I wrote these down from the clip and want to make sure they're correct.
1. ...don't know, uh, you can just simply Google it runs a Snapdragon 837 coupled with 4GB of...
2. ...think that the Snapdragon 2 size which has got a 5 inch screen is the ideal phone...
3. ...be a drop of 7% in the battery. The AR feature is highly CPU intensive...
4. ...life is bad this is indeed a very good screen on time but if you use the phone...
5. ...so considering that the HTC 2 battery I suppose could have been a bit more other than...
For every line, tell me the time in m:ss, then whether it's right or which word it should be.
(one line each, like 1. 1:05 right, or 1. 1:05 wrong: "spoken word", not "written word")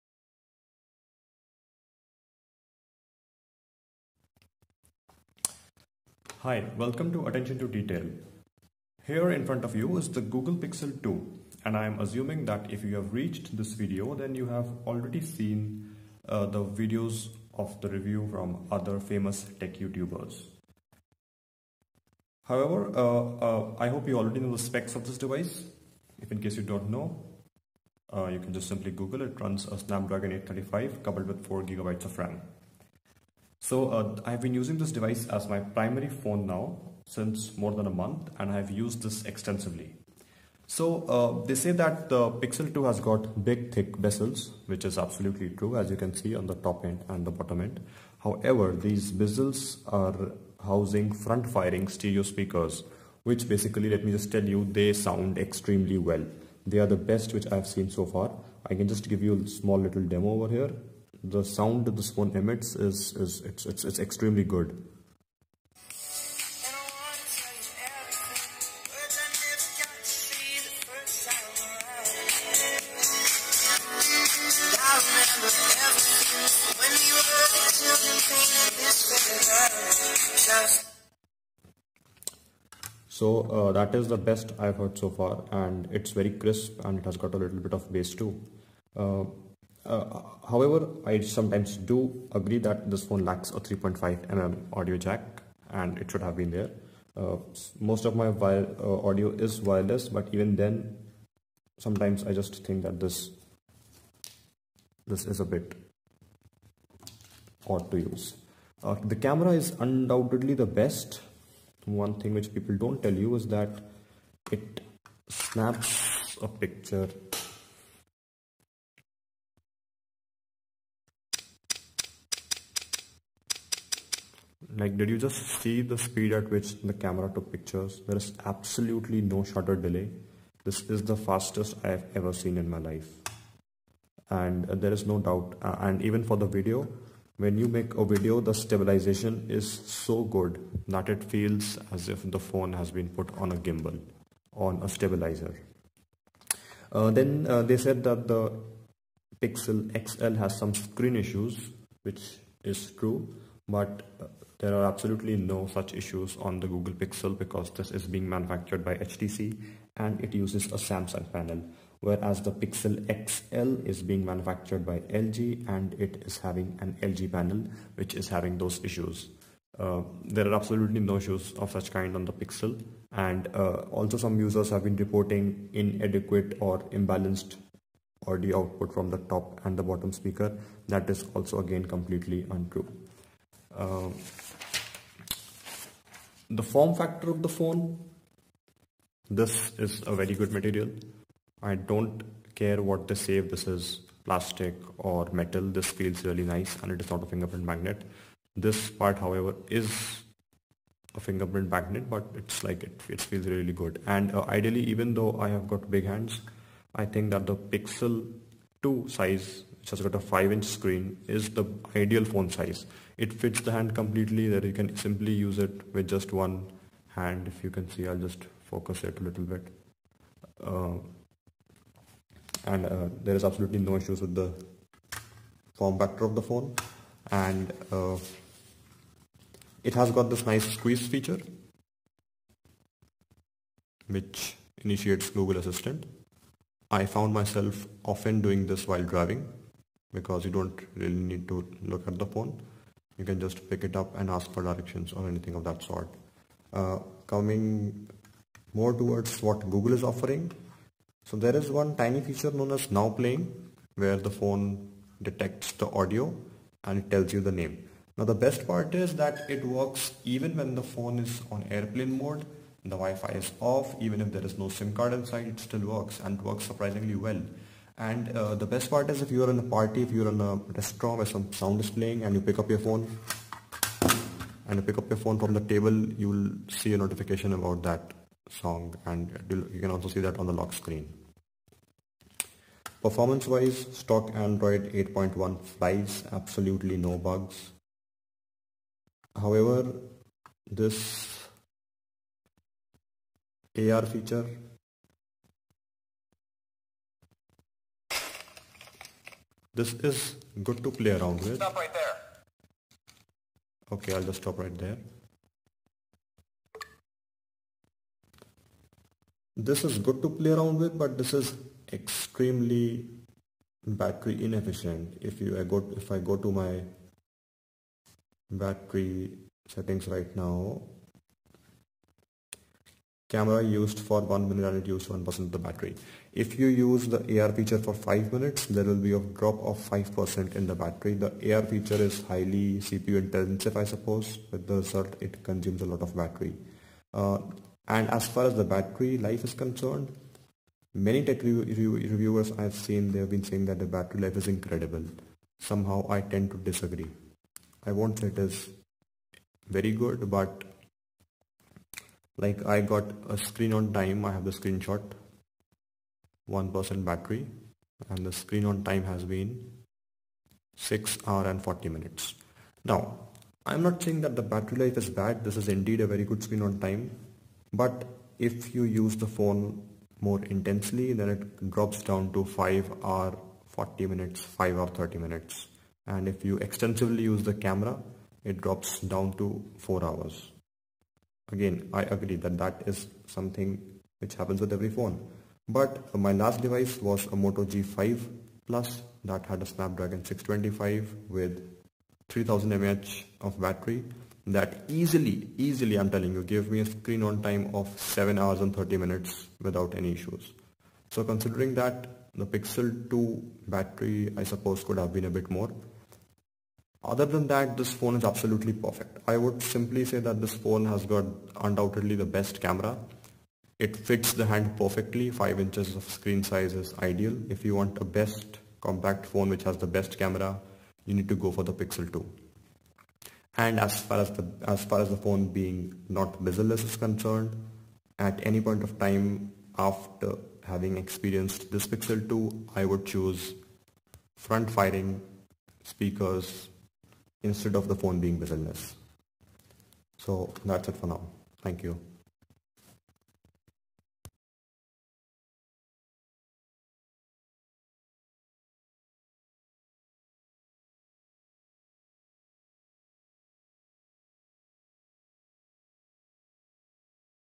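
1. 0:26 wrong: "835", not "837"
2. 3:27 wrong: "Pixel", not "Snapdragon"
3. 5:29 wrong: "5", not "7"
4. 6:04 right
5. 6:41 wrong: "Pixel", not "HTC".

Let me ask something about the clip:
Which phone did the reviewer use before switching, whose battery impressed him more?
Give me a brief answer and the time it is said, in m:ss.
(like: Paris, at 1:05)
Moto G5 Plus, at 6:27.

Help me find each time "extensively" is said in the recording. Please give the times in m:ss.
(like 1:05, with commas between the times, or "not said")
0:39, 6:16.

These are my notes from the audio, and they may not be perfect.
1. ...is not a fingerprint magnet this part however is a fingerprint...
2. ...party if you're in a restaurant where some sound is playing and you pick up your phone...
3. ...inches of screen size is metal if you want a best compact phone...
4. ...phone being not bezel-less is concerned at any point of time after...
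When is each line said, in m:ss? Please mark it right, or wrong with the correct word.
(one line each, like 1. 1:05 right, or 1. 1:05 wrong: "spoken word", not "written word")
1. 3:16 right
2. 4:29 right
3. 6:55 wrong: "ideal", not "metal"
4. 7:05 right.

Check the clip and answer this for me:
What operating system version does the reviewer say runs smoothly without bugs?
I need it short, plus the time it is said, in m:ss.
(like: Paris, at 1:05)
Android 8.1, at 4:44.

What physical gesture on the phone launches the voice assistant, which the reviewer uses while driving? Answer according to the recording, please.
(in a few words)
squeeze.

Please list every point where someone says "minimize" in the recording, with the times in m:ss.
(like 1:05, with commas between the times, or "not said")
not said.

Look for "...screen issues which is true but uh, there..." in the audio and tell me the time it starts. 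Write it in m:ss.
2:30.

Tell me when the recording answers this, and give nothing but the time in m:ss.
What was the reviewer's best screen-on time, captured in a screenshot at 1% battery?
6:00.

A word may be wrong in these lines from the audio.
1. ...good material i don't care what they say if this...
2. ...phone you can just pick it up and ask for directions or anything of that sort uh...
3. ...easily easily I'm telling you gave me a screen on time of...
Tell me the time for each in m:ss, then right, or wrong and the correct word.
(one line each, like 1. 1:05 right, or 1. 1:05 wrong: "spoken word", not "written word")
1. 3:10 right
2. 4:02 right
3. 6:34 right.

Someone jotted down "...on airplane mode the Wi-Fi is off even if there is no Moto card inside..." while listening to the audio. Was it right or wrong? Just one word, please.
wrong.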